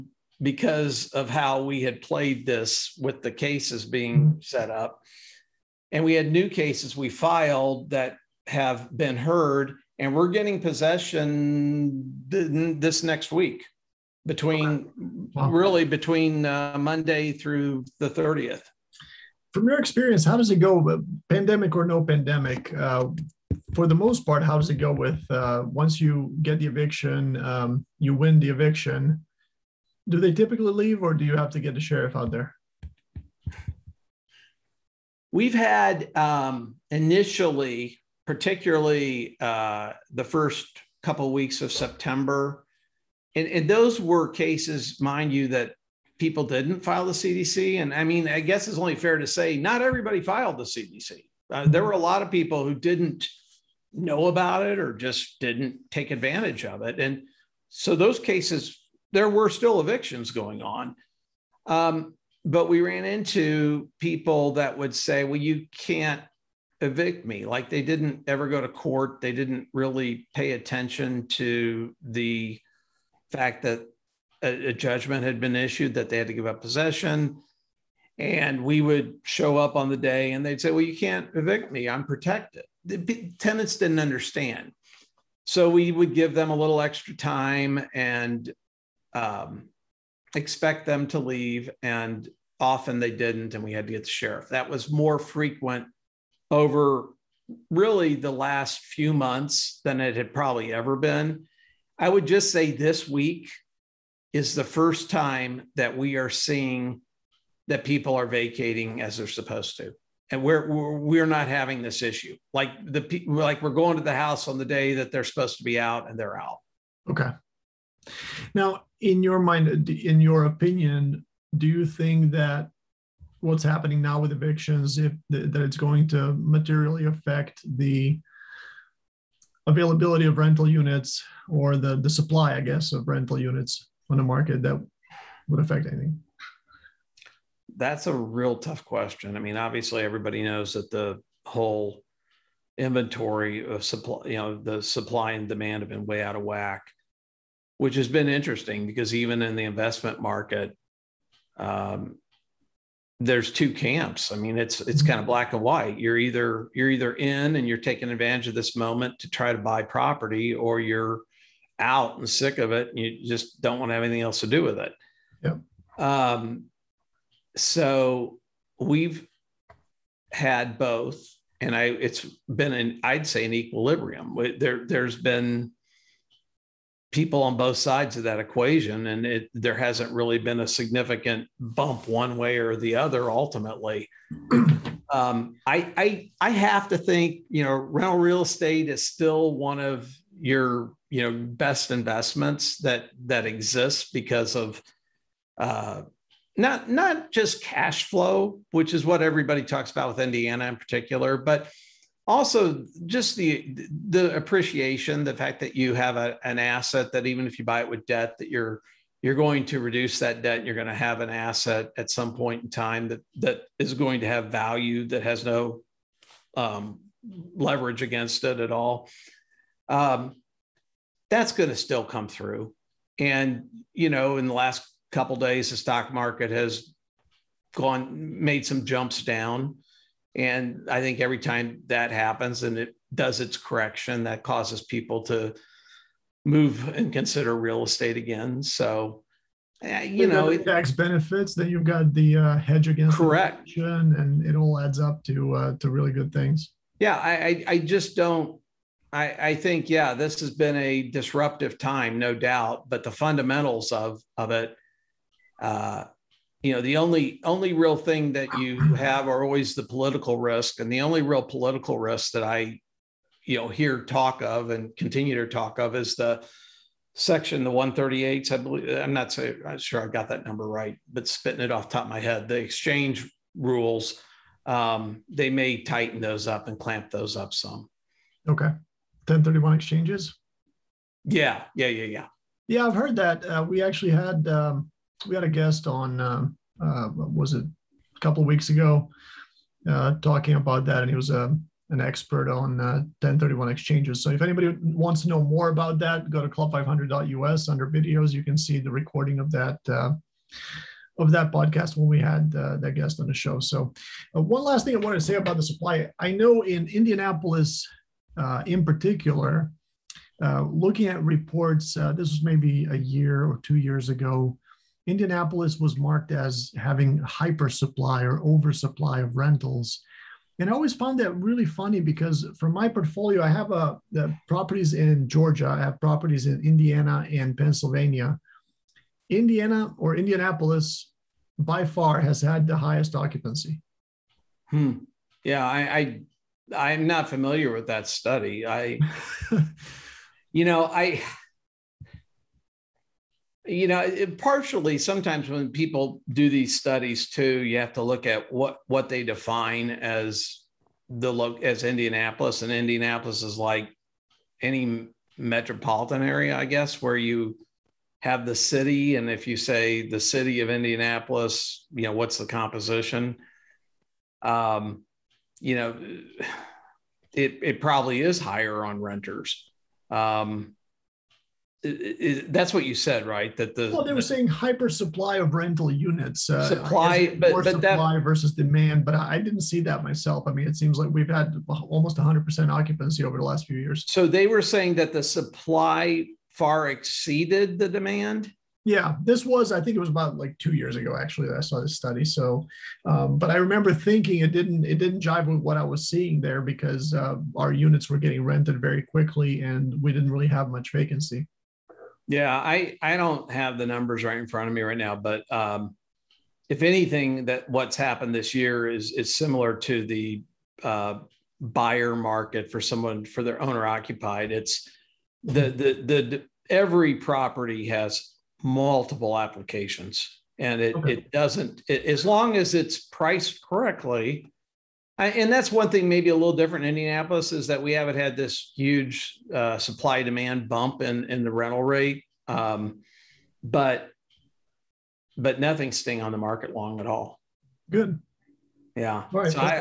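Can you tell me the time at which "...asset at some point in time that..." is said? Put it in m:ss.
3:31.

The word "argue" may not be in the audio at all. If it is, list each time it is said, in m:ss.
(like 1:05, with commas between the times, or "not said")
not said.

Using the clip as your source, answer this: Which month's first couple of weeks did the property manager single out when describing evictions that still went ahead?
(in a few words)
September.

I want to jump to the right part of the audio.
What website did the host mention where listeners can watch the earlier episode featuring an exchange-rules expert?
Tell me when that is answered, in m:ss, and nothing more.
4:56.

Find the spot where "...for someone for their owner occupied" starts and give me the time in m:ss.
6:52.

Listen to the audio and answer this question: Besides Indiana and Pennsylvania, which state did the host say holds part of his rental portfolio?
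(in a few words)
Georgia.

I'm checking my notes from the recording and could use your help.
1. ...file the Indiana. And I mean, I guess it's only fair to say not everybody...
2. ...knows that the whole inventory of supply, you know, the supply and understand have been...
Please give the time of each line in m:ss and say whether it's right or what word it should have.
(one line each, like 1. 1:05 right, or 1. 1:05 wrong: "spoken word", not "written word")
1. 0:46 wrong: "CDC", not "Indiana"
2. 2:20 wrong: "demand", not "understand".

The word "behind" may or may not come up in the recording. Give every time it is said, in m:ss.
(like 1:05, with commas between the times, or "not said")
not said.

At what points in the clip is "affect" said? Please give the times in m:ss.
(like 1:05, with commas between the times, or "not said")
2:07, 2:15.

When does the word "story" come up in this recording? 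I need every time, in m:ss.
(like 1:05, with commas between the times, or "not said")
not said.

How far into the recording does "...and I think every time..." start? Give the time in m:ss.
3:50.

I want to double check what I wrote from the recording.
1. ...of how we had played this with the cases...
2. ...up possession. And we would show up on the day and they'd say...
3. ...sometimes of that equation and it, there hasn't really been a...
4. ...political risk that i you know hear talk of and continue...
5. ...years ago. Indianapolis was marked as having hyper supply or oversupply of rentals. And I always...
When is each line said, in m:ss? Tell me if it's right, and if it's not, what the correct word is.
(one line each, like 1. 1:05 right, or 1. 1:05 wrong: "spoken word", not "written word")
1. 0:01 right
2. 1:16 right
3. 2:57 wrong: "sides", not "sometimes"
4. 4:21 right
5. 5:13 right.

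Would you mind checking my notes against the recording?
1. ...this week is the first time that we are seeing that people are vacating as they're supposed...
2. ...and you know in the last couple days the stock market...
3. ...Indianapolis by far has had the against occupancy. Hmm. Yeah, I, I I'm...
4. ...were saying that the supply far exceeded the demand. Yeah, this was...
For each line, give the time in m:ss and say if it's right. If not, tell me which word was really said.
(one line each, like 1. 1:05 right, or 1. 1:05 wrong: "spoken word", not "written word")
1. 1:42 right
2. 3:43 right
3. 5:30 wrong: "highest", not "against"
4. 6:24 right.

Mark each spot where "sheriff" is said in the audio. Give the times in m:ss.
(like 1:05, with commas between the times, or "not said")
0:31, 1:34.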